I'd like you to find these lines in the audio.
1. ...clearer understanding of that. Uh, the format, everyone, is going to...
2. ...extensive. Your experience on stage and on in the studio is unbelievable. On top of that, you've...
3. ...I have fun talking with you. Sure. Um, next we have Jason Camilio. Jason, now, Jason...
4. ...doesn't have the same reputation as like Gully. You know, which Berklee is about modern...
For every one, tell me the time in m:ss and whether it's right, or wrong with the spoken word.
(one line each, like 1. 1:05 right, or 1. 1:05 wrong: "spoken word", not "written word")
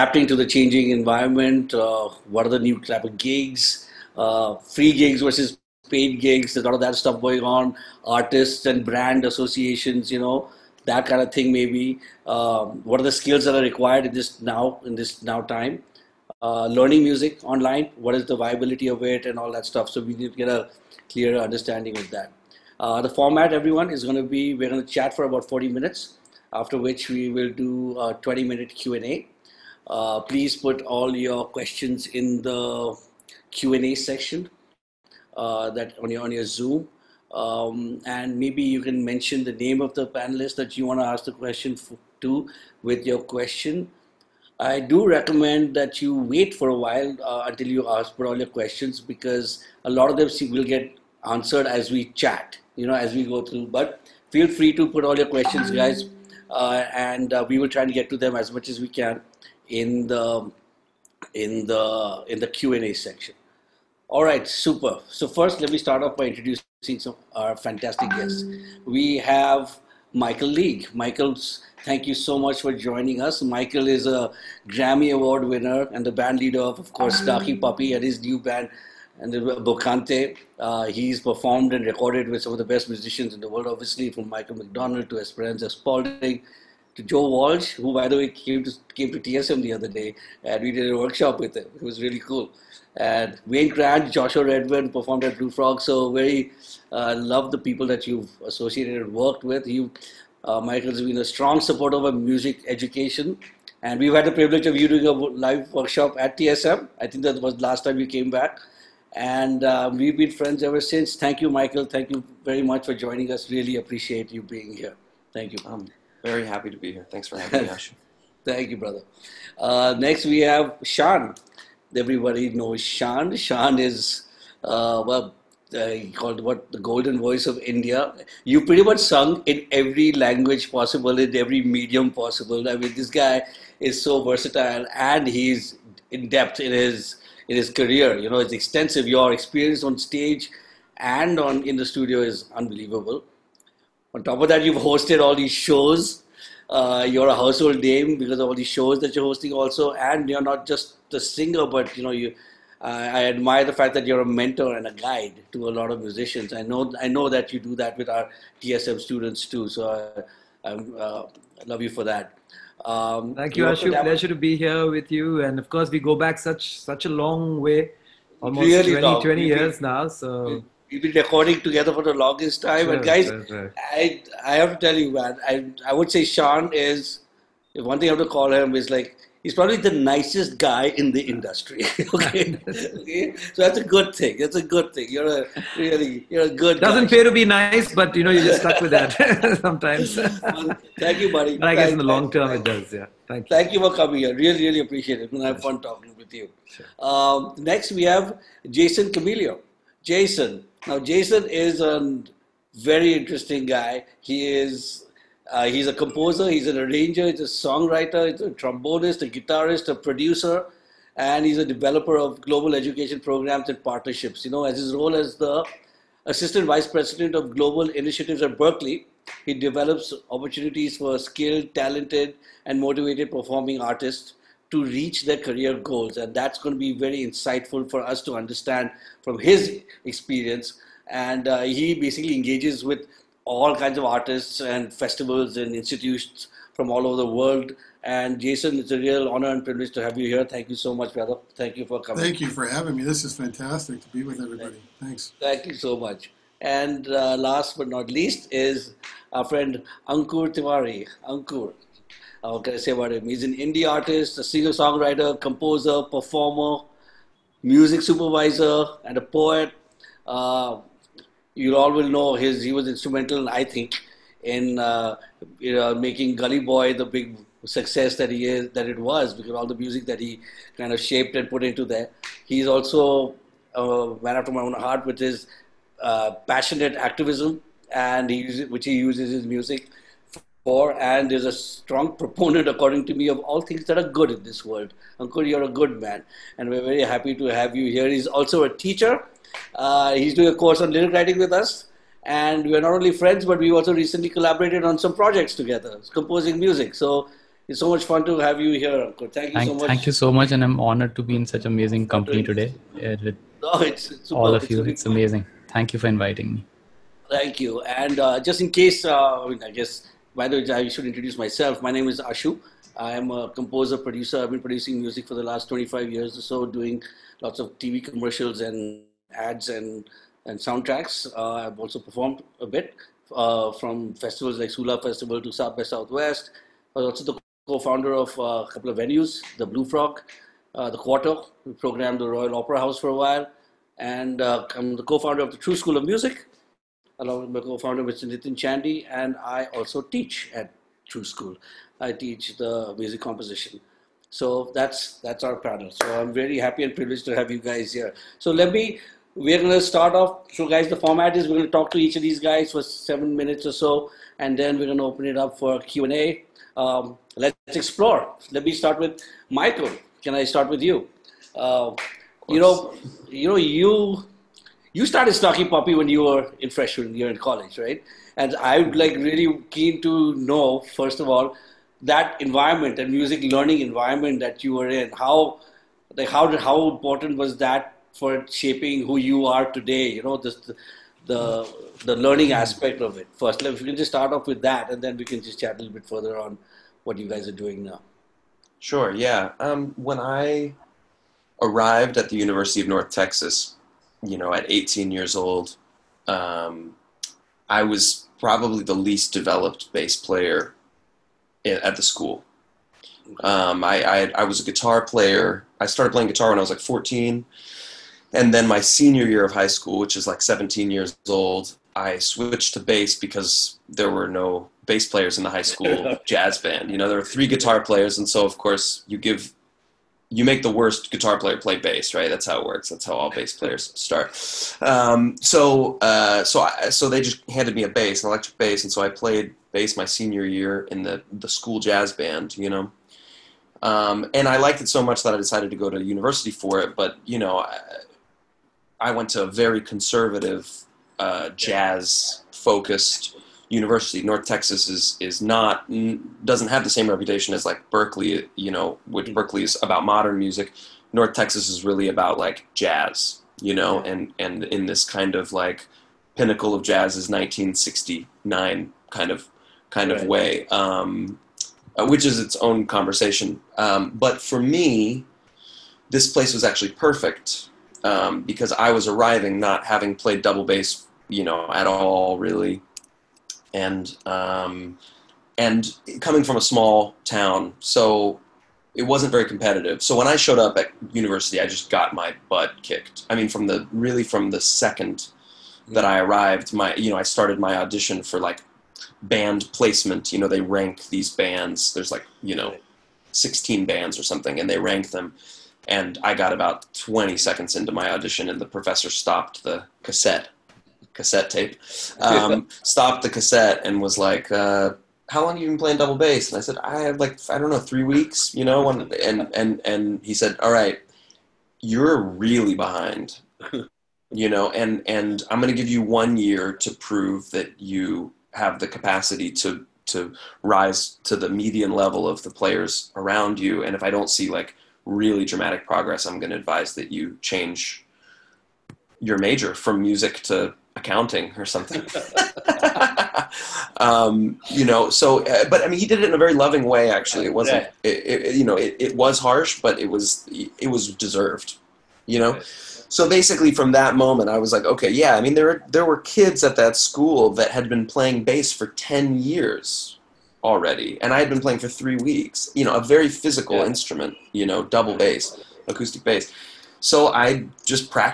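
1. 0:21 right
2. 2:18 right
3. 3:15 right
4. 7:26 wrong: "Berklee", not "Gully".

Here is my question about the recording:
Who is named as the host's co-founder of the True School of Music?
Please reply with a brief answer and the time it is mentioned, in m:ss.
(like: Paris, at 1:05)
Nitin Chandy, at 5:38.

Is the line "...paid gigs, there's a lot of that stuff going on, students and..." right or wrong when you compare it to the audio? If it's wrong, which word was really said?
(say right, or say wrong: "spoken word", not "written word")
wrong: "artists", not "students".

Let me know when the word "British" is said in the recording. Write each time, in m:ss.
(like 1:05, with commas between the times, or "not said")
not said.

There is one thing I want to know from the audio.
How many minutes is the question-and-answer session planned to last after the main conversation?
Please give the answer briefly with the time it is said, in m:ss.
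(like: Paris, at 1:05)
20, at 0:28.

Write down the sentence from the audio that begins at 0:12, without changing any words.
Um, what are the skills that are required in this now, in this now time?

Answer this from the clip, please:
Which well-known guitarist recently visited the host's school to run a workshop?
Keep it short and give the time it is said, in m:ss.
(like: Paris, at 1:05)
Joe Walsh, at 1:27.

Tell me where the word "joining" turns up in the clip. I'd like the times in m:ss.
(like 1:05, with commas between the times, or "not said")
1:12, 1:52.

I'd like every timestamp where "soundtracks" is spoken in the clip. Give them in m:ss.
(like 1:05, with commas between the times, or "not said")
5:20.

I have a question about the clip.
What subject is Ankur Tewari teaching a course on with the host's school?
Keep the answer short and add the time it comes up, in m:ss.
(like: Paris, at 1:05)
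Lyric writing, at 4:50.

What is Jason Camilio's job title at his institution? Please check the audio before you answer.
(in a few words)
Assistant vice president of global initiatives.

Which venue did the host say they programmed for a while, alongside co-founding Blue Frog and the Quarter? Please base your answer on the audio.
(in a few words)
Royal Opera House.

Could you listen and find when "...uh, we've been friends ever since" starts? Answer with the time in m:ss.
1:49.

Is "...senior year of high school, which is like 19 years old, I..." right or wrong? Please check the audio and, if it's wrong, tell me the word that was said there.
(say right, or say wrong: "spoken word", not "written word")
wrong: "17", not "19".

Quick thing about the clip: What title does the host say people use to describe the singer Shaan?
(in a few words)
The golden voice of India.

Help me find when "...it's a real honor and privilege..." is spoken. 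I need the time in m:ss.
3:58.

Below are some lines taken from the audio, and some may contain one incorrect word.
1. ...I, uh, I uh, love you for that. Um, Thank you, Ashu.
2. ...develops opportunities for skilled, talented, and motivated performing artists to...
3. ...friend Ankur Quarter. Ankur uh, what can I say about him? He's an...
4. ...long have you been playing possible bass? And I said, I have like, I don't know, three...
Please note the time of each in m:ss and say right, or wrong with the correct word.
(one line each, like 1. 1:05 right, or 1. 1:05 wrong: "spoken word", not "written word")
1. 2:39 right
2. 3:39 right
3. 4:09 wrong: "Tewari", not "Quarter"
4. 8:25 wrong: "double", not "possible".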